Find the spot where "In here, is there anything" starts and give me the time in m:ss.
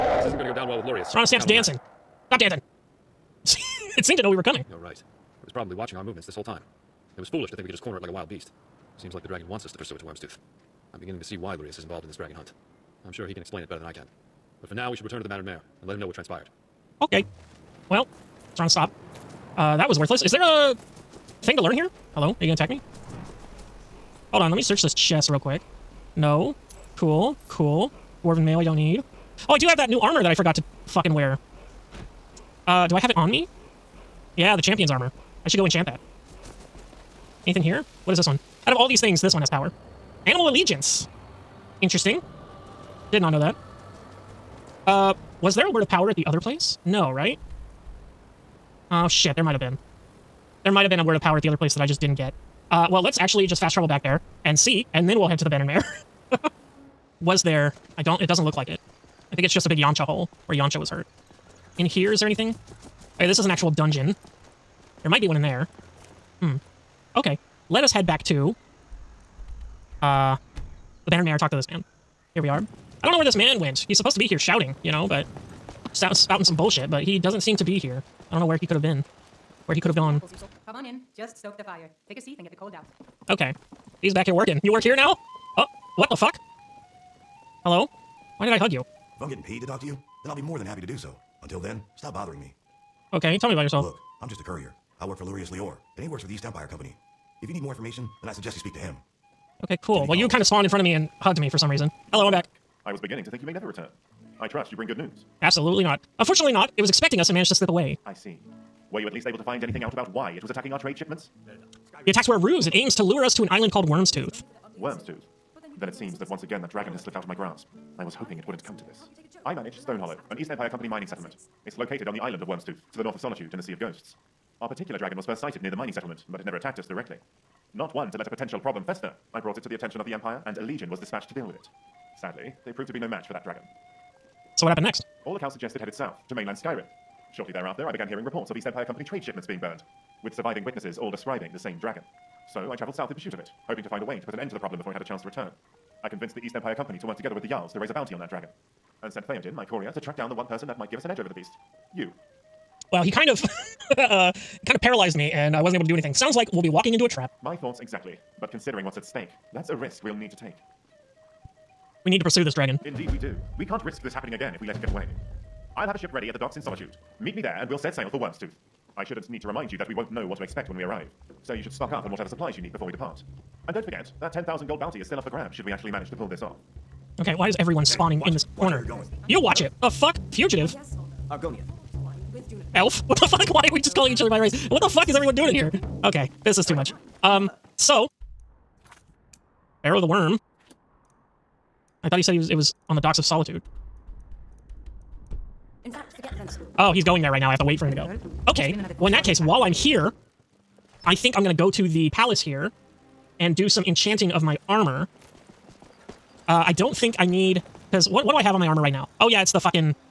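1:01.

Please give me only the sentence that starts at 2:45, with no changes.
I'll have a ship ready at the docks in Solitude.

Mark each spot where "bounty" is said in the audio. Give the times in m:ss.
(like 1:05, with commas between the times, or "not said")
2:27, 2:54.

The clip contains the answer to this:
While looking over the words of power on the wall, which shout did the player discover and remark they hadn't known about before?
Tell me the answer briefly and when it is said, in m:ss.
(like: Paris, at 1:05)
Animal Allegiance, at 0:40.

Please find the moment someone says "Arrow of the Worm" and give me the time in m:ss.
3:09.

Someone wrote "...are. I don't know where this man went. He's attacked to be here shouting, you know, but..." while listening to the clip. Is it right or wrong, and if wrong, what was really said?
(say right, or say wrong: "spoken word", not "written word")
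wrong: "supposed", not "attacked".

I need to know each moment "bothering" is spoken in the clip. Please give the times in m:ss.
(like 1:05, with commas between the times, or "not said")
1:32.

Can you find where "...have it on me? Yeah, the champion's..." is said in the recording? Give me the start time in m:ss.
0:32.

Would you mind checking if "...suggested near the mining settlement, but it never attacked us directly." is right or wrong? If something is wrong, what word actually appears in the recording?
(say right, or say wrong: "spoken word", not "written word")
wrong: "sighted", not "suggested".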